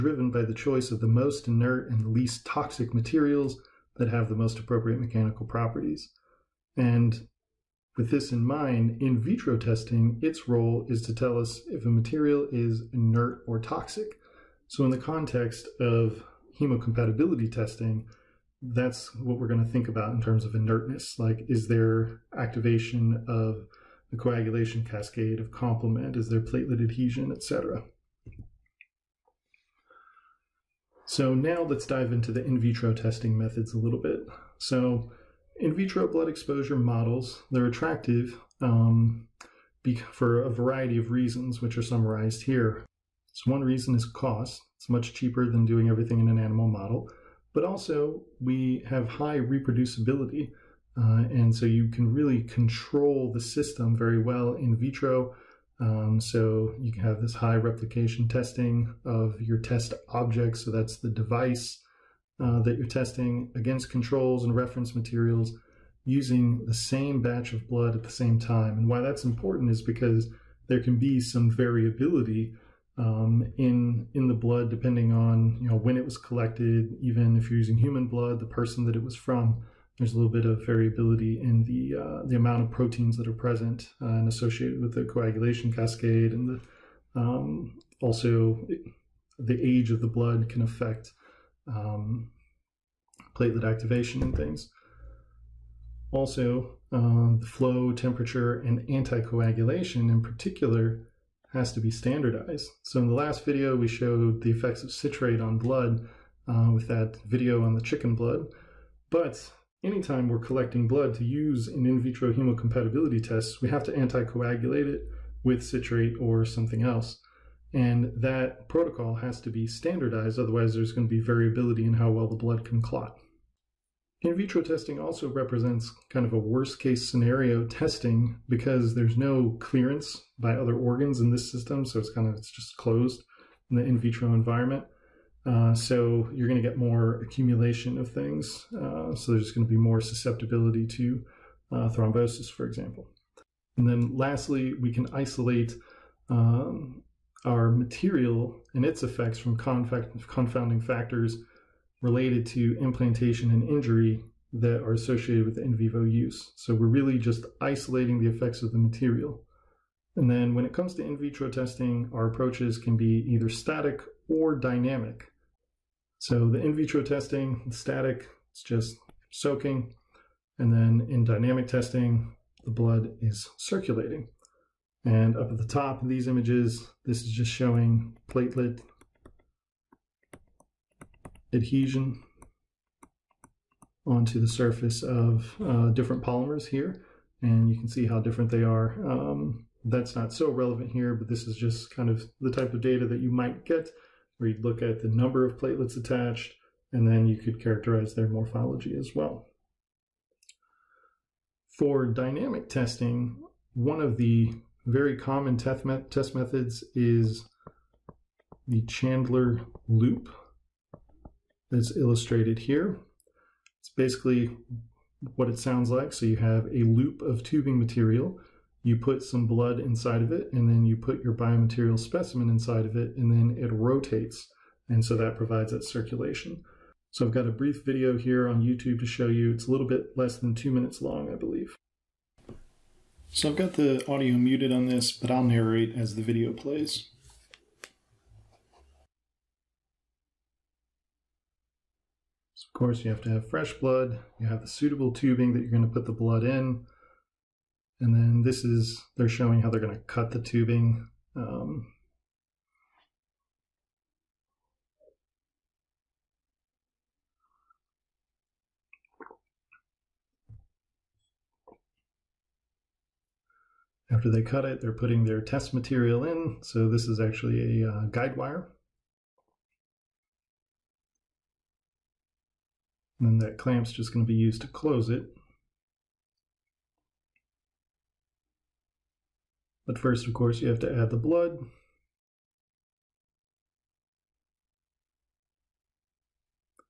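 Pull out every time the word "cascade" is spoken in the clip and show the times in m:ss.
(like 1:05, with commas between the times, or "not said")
0:24, 1:25.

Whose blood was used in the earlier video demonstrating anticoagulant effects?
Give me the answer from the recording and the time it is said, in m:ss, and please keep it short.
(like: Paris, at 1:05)
chicken, at 1:47.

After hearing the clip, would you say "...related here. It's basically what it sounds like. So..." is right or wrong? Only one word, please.
wrong.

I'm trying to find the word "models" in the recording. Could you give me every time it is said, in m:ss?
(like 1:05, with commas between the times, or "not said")
0:36, 0:46.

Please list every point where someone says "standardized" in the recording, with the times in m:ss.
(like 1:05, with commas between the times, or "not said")
1:41, 1:59.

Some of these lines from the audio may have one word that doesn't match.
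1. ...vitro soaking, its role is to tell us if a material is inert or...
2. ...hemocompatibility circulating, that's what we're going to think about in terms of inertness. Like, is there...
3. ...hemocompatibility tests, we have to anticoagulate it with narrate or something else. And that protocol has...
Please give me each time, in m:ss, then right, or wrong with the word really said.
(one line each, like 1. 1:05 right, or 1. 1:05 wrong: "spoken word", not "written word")
1. 0:09 wrong: "testing", not "soaking"
2. 0:16 wrong: "testing", not "circulating"
3. 1:52 wrong: "citrate", not "narrate".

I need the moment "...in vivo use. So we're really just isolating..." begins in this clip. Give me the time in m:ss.
2:35.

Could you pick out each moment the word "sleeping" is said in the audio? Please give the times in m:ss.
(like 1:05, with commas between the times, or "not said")
not said.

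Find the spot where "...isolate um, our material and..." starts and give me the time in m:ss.
2:25.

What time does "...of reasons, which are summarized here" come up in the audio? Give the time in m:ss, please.
0:40.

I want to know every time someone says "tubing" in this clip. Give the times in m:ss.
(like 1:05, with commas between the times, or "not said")
3:37, 4:05, 4:10.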